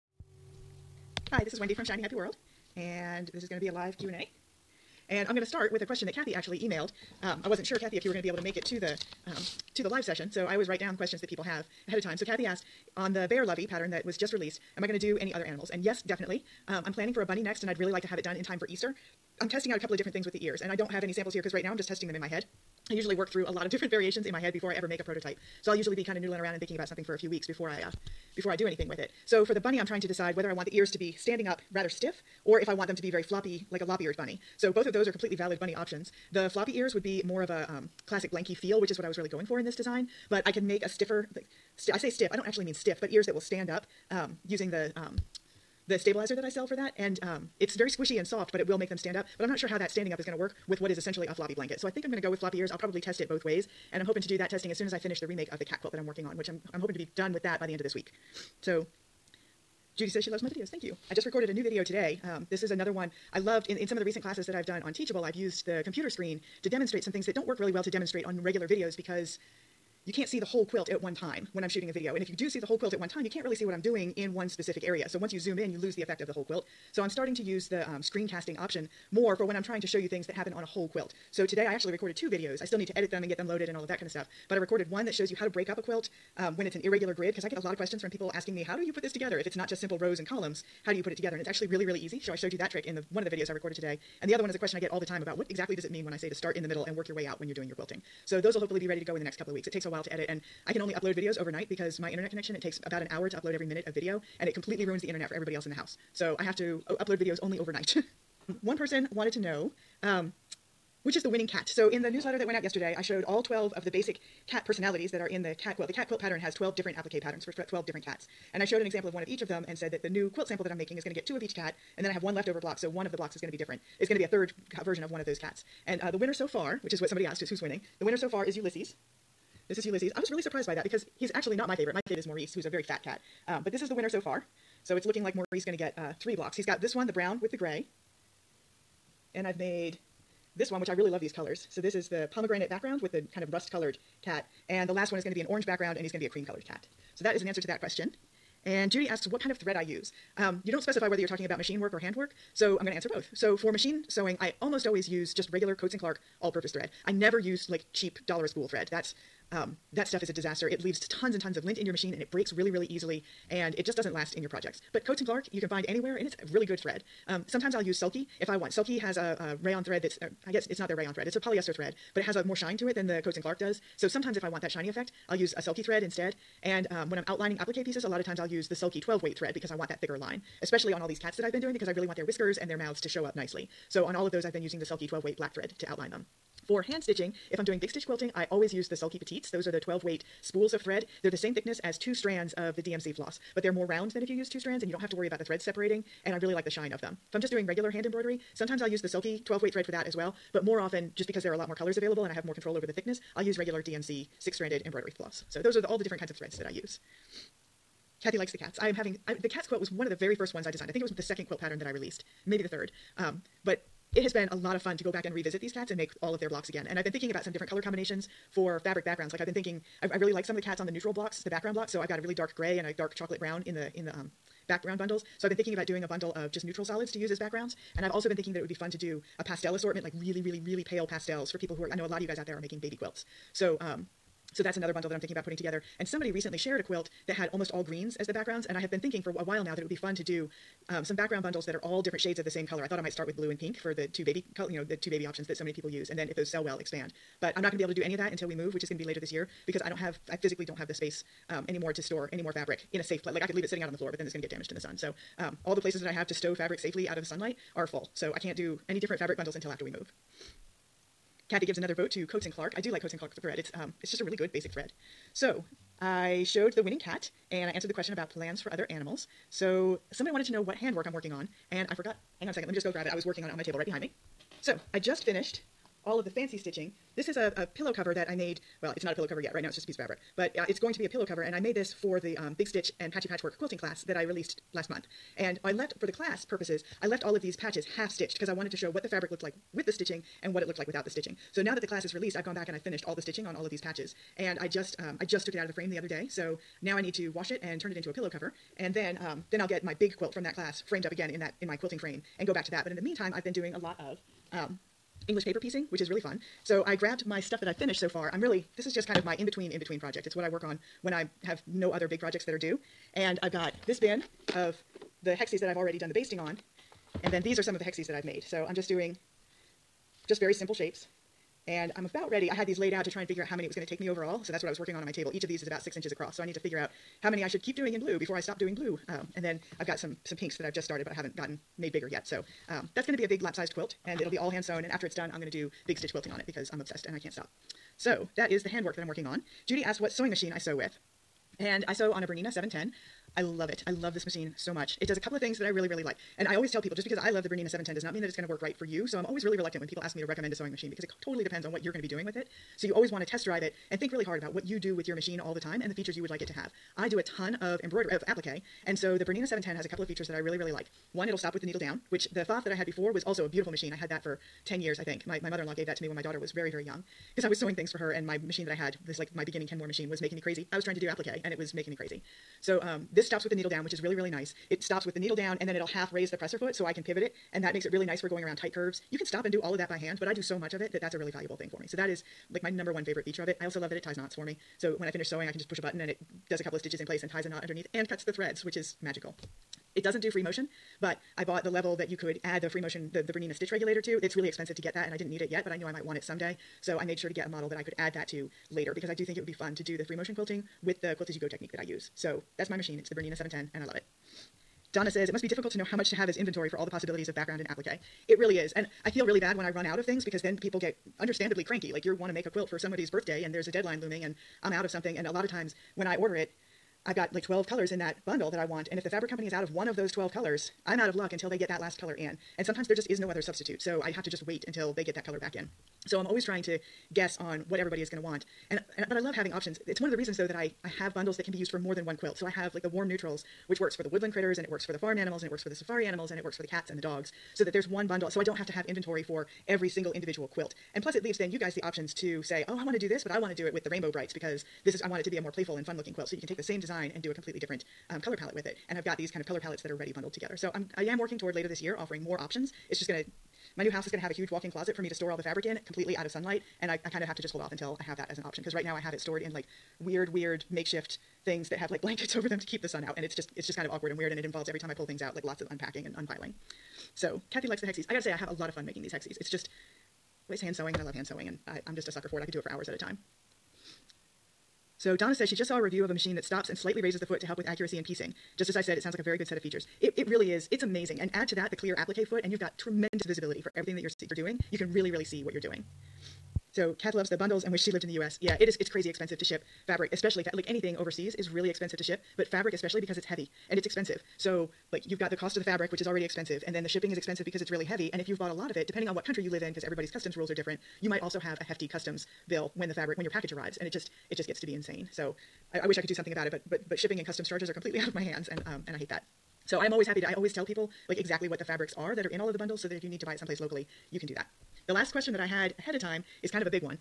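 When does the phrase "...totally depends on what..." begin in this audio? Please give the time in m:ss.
5:51.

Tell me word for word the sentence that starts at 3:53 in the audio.
So, um, so that's another bundle that I'm thinking about putting together.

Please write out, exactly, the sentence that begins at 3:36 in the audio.
And I've been thinking about some different color combinations for fabric backgrounds.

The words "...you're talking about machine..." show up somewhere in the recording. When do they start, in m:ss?
2:31.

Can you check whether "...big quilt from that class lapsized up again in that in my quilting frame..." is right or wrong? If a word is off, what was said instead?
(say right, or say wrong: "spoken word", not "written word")
wrong: "framed", not "lapsized".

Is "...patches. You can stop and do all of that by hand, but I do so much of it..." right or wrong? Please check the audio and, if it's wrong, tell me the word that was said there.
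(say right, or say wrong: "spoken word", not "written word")
wrong: "curves", not "patches".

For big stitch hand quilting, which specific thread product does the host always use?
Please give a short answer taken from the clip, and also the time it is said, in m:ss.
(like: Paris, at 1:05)
Sulky Petites, at 3:08.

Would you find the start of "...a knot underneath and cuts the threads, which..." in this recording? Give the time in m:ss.
6:27.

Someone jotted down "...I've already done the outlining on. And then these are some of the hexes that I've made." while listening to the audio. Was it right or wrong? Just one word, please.
wrong.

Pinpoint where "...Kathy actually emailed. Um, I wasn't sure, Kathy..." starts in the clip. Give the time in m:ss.
0:06.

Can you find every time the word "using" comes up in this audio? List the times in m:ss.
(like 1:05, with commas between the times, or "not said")
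0:44, 3:04.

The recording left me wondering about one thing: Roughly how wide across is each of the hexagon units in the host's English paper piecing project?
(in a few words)
6 inches.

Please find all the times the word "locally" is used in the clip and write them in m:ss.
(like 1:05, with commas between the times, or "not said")
8:33.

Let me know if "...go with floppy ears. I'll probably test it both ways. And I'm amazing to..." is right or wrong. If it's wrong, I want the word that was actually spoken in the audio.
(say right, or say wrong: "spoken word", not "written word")
wrong: "hoping", not "amazing".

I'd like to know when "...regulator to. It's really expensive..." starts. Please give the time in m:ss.
6:33.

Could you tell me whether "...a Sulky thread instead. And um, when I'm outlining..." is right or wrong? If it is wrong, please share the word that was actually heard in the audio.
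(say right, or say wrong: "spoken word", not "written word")
right.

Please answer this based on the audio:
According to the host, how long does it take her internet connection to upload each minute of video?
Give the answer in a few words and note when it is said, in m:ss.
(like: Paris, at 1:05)
About an hour, at 1:42.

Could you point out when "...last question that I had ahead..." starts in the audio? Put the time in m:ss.
8:34.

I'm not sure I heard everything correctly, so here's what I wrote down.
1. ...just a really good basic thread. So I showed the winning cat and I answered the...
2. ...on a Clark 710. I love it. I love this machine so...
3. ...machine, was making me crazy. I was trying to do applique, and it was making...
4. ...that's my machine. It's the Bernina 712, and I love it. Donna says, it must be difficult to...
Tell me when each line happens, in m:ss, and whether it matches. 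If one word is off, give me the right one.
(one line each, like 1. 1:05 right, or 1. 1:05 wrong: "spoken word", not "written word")
1. 4:24 right
2. 5:42 wrong: "Bernina", not "Clark"
3. 6:09 right
4. 6:42 wrong: "710", not "712".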